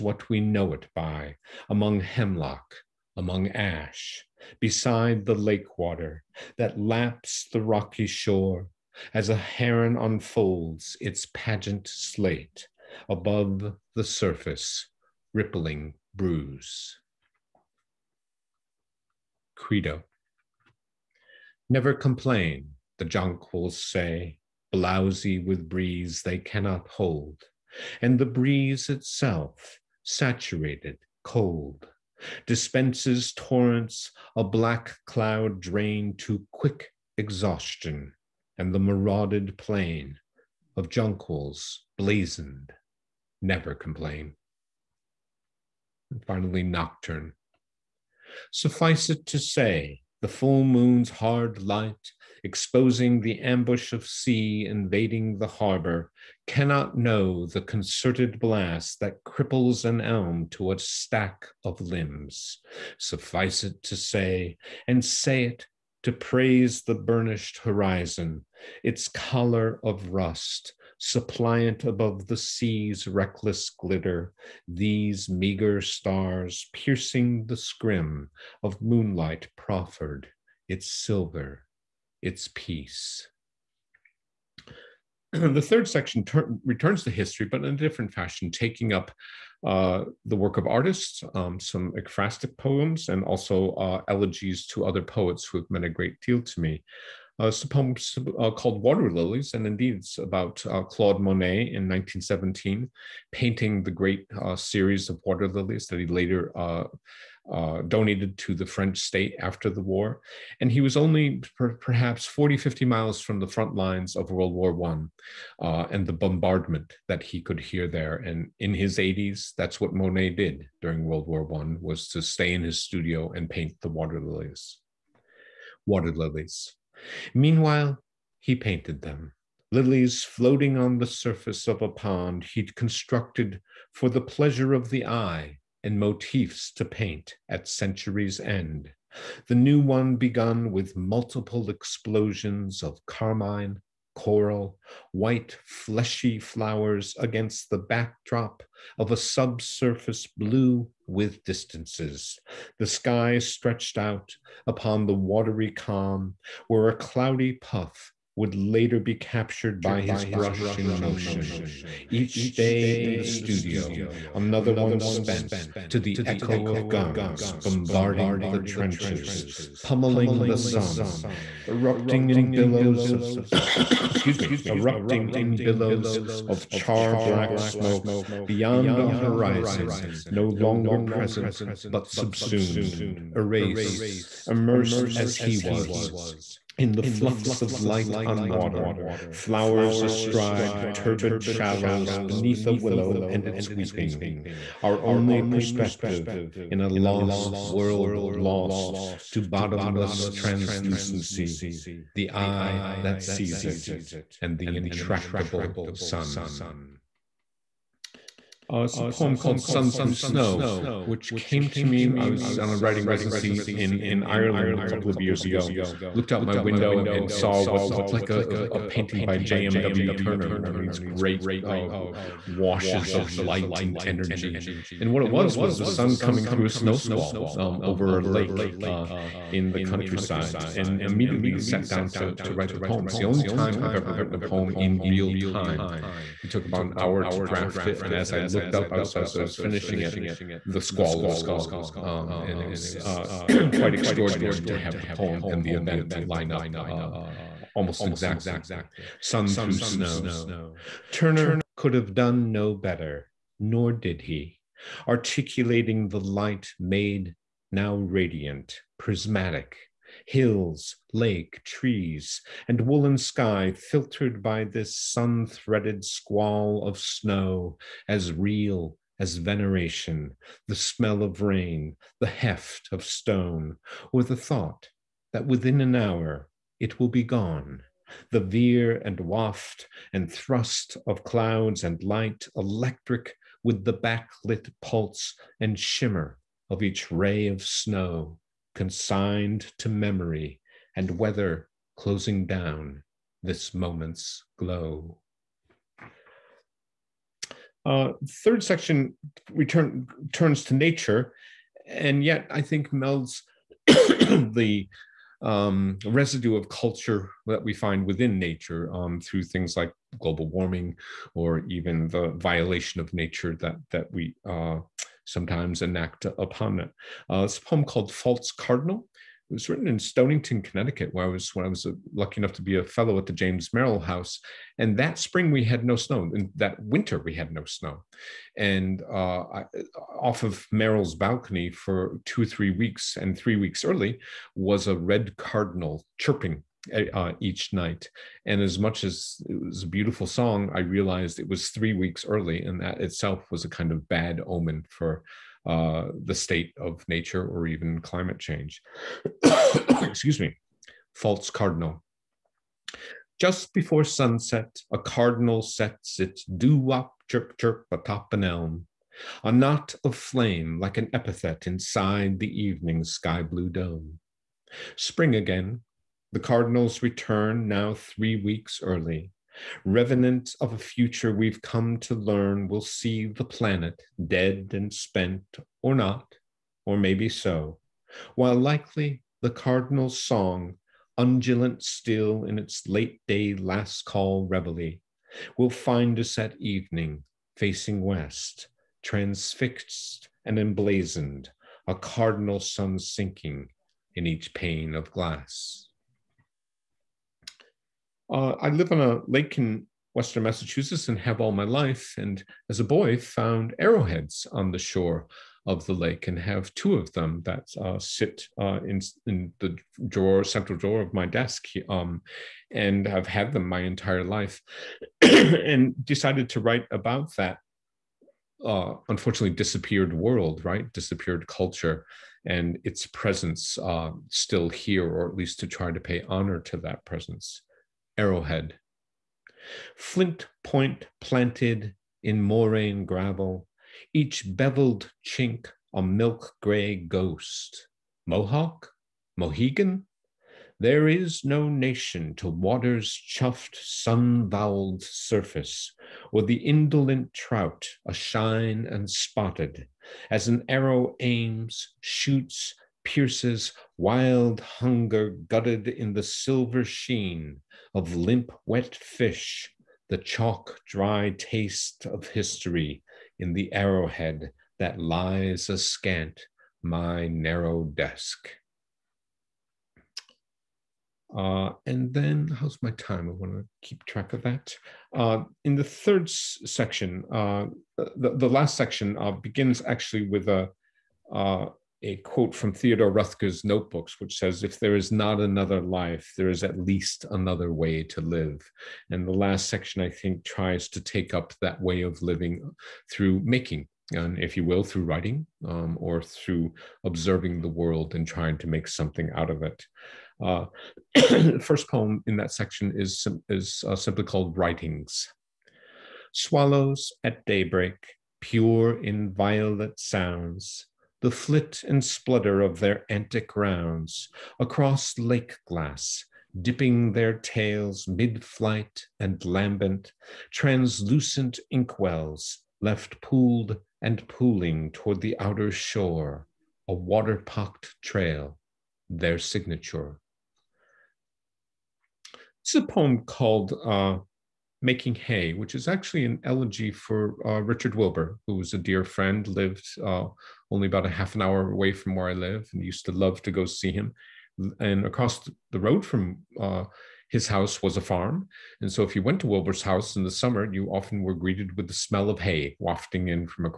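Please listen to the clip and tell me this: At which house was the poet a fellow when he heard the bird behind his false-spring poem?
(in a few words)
James Merrill House.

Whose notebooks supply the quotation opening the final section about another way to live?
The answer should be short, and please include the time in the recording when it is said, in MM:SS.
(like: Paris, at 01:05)
Theodore Rothko, at 08:02.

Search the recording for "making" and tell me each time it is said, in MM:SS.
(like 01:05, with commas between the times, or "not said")
08:13, 08:54.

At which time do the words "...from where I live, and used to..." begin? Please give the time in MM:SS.
09:01.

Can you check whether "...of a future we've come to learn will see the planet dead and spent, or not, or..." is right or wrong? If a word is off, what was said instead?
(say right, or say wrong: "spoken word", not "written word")
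right.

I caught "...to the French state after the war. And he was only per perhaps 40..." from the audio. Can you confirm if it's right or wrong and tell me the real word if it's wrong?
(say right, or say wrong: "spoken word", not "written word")
right.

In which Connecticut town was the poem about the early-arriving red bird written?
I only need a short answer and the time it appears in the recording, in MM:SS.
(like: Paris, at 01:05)
Stonington, at 05:19.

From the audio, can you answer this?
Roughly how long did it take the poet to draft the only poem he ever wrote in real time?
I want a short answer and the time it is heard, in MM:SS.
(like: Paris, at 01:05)
About an hour, at 03:56.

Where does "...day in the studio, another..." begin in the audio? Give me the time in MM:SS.
02:42.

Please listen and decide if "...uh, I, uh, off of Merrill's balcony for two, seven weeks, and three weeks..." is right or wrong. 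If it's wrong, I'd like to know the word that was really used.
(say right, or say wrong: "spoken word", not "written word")
wrong: "three", not "seven".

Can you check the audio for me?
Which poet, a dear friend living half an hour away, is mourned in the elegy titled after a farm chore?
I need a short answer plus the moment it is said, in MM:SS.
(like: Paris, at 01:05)
Richard Wilbur, at 08:57.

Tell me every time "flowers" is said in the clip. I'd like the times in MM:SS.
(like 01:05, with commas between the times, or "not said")
02:26, 03:09.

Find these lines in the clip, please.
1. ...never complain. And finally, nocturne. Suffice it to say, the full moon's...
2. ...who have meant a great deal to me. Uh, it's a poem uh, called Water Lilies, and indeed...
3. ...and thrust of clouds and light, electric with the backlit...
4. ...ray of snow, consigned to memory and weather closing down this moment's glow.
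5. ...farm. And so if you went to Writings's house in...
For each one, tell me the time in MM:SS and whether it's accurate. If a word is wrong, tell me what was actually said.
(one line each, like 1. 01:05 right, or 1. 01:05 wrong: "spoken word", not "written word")
1. 00:43 right
2. 01:35 right
3. 04:40 right
4. 04:47 right
5. 09:08 wrong: "Wilbur", not "Writings".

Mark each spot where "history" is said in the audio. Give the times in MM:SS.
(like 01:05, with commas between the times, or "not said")
01:27, 07:42.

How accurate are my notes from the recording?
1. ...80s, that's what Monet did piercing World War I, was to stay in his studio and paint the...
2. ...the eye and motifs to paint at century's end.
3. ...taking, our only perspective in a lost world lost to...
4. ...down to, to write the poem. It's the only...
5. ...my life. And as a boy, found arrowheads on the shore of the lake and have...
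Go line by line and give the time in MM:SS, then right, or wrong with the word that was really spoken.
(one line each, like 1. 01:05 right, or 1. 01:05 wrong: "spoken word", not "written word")
1. 01:58 wrong: "during", not "piercing"
2. 02:14 right
3. 03:13 wrong: "weeping", not "taking"
4. 03:51 right
5. 06:41 right.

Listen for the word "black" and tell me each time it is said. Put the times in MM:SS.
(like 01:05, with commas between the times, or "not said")
00:34, 02:57.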